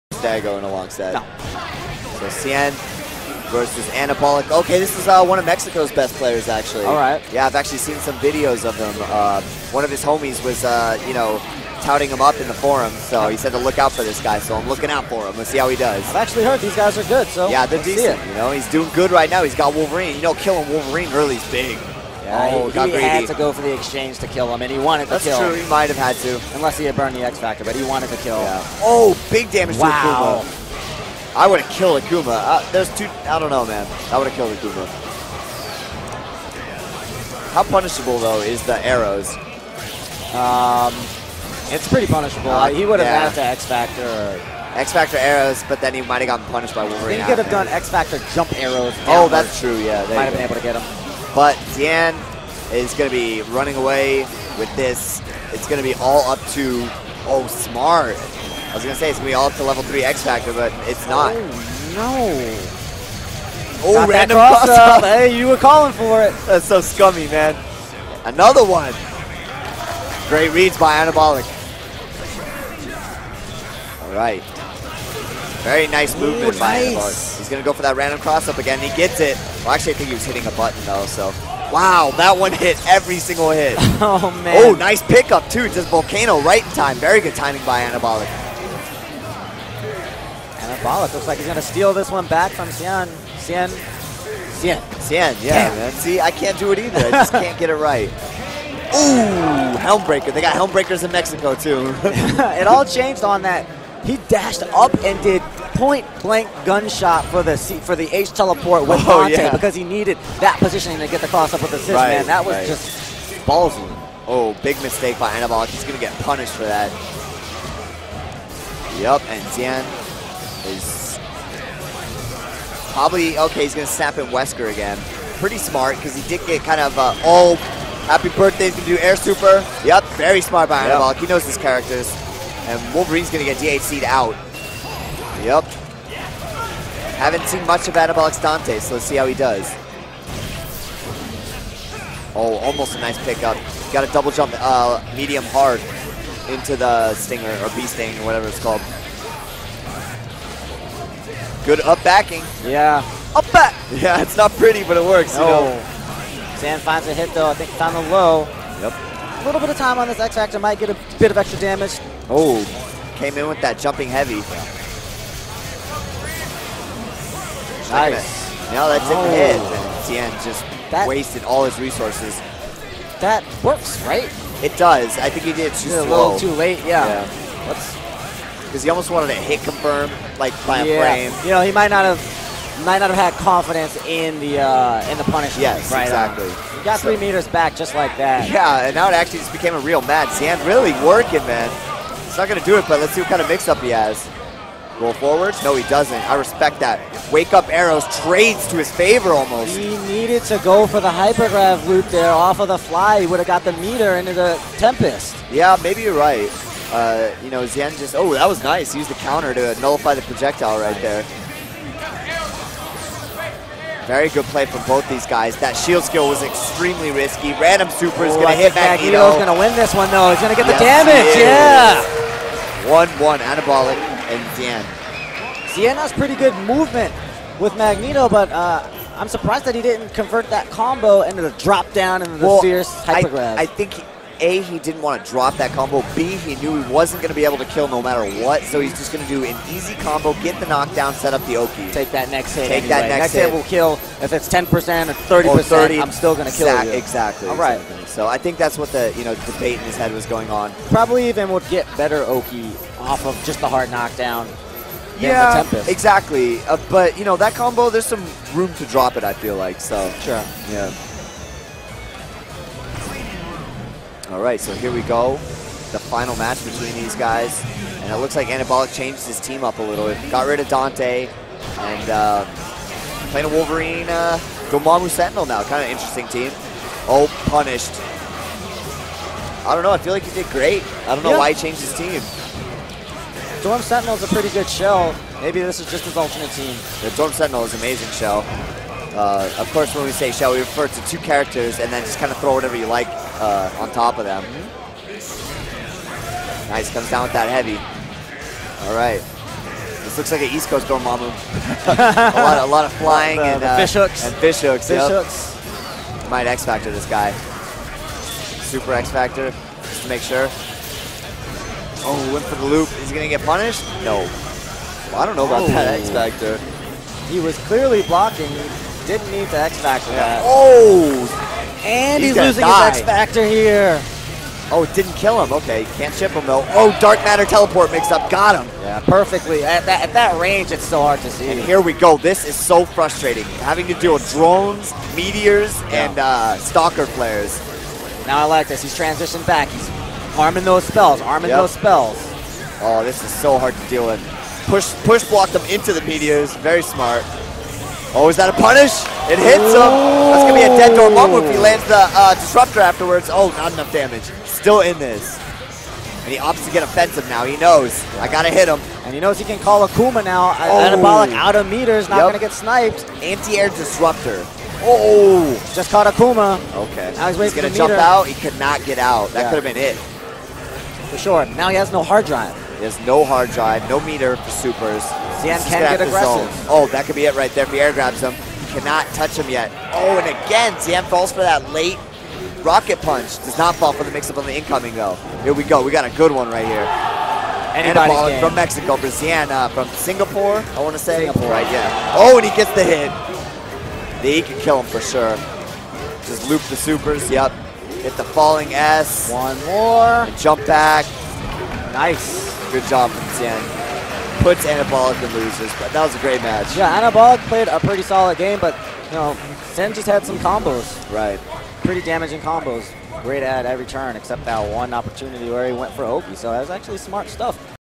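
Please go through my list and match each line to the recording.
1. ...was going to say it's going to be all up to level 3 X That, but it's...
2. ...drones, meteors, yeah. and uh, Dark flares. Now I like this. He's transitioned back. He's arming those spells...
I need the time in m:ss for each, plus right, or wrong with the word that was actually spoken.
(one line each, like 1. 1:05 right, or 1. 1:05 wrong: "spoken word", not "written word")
1. 0:58 wrong: "Factor", not "That"
2. 5:34 wrong: "Stalker", not "Dark".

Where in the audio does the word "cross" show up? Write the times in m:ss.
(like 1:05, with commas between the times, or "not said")
1:04, 1:18, 1:51.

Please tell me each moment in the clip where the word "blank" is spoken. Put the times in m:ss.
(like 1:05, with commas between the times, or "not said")
1:46.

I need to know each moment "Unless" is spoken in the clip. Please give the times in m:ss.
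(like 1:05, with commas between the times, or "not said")
0:26.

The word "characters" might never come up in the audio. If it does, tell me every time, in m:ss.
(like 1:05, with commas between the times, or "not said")
2:11, 4:51.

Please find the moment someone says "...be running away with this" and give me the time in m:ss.
0:53.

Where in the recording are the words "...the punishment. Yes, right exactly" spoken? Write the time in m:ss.
3:05.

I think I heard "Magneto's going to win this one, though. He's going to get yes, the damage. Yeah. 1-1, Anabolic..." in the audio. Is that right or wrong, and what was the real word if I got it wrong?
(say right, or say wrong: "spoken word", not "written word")
right.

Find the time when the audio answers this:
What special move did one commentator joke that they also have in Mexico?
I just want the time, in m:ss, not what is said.
1:40.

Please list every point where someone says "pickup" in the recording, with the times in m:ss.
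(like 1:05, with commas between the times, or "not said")
1:25, 2:23.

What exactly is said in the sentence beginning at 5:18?
He didn't need to X Factor yeah.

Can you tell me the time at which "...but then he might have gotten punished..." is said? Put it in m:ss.
0:45.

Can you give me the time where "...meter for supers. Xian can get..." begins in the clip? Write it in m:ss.
6:14.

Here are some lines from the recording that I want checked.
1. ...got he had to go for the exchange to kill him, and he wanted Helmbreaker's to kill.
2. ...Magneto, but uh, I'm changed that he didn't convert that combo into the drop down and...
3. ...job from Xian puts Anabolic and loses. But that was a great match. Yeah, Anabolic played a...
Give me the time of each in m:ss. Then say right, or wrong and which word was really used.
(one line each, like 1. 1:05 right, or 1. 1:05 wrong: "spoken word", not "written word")
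1. 0:22 wrong: "That", not "Helmbreaker"
2. 3:47 wrong: "surprised", not "changed"
3. 6:42 right.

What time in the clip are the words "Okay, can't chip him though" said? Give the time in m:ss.
5:25.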